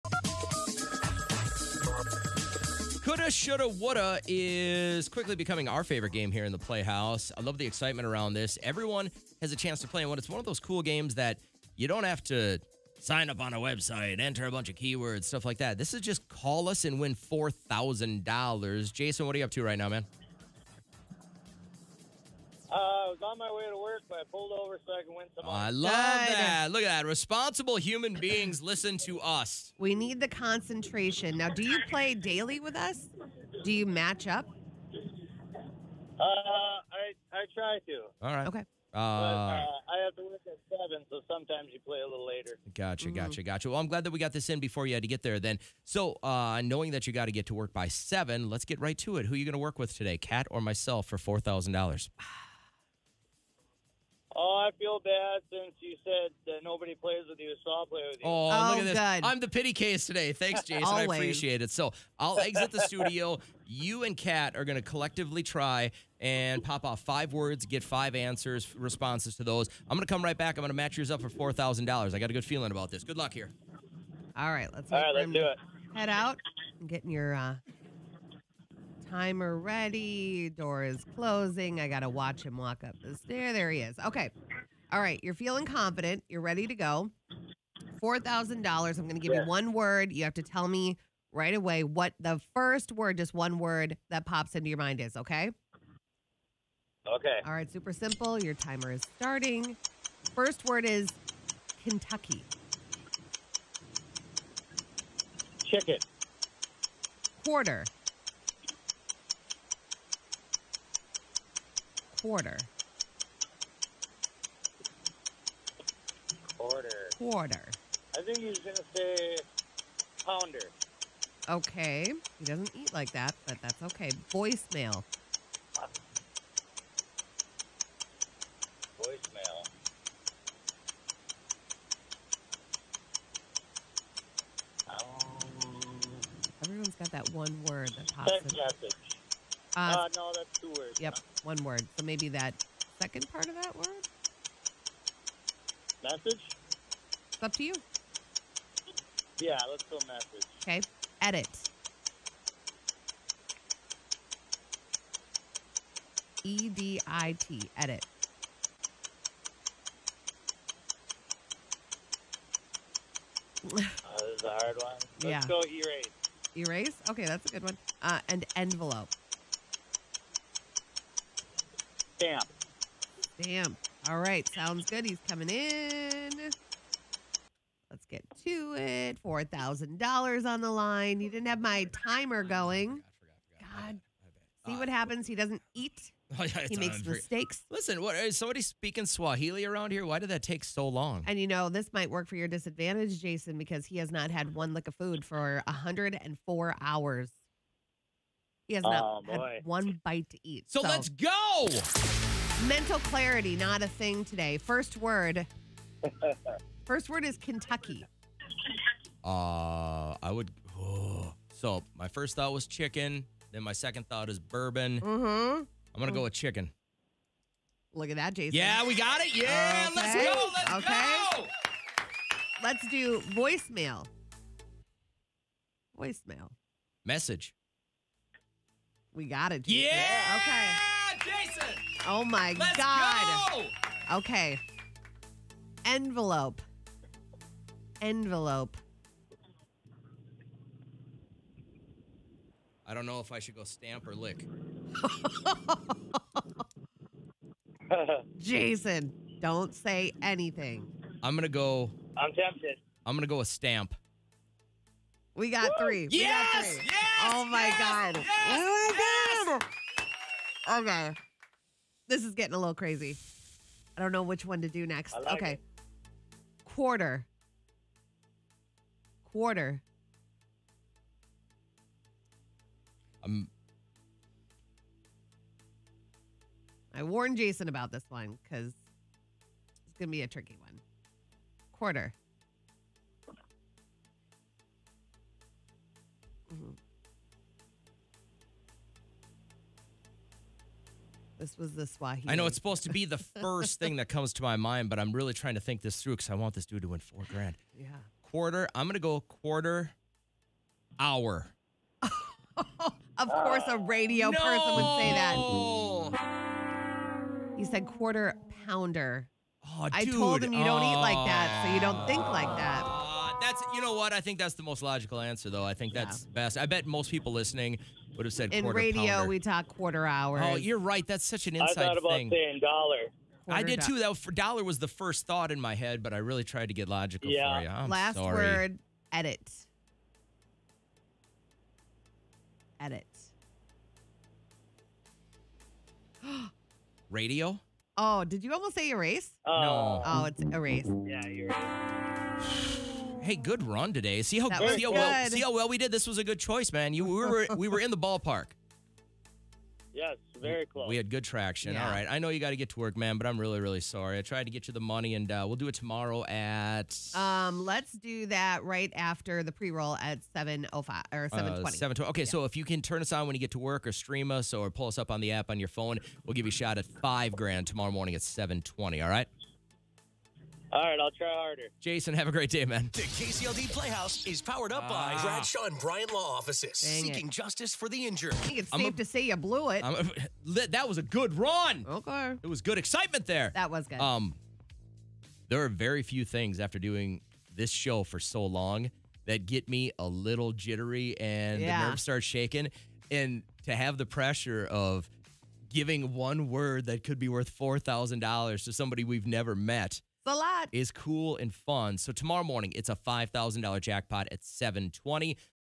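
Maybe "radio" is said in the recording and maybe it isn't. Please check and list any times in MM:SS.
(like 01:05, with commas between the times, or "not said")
05:03, 05:18, 05:37.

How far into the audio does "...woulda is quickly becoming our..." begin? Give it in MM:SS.
00:03.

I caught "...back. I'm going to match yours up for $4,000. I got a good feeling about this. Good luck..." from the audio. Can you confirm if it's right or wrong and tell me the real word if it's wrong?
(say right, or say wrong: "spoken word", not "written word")
right.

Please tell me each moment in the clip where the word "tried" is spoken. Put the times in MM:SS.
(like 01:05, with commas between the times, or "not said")
05:26, 05:54.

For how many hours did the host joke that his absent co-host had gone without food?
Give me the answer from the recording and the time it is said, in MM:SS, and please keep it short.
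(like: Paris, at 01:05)
104, at 03:15.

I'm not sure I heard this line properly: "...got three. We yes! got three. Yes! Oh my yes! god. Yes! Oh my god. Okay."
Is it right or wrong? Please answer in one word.
right.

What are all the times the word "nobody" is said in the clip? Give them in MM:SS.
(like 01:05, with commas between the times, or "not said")
00:56.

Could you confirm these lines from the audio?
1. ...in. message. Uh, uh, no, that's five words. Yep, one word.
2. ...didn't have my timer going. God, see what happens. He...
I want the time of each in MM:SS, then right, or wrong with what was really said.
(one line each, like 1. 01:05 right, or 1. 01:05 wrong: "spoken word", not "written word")
1. 02:18 wrong: "two", not "five"
2. 03:01 right.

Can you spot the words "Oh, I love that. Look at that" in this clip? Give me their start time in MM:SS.
00:25.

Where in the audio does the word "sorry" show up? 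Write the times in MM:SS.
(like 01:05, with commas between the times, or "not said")
05:28, 05:53.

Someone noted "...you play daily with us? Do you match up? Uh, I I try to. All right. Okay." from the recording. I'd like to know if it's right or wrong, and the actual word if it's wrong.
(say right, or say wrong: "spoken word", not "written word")
right.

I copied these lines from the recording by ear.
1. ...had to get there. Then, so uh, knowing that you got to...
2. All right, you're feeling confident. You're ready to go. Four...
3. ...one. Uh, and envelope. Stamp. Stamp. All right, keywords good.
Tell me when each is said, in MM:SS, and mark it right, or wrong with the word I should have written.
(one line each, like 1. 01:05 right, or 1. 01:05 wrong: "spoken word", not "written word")
1. 00:44 right
2. 01:24 right
3. 02:47 wrong: "sounds", not "keywords".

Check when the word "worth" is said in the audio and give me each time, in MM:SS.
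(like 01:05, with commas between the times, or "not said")
06:37.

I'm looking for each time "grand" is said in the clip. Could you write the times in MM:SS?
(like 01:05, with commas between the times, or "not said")
04:57, 06:07.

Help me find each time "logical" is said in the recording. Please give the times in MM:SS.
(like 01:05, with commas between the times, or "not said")
05:14, 05:26.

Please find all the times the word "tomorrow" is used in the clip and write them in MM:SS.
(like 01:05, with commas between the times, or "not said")
05:55, 06:07, 06:42.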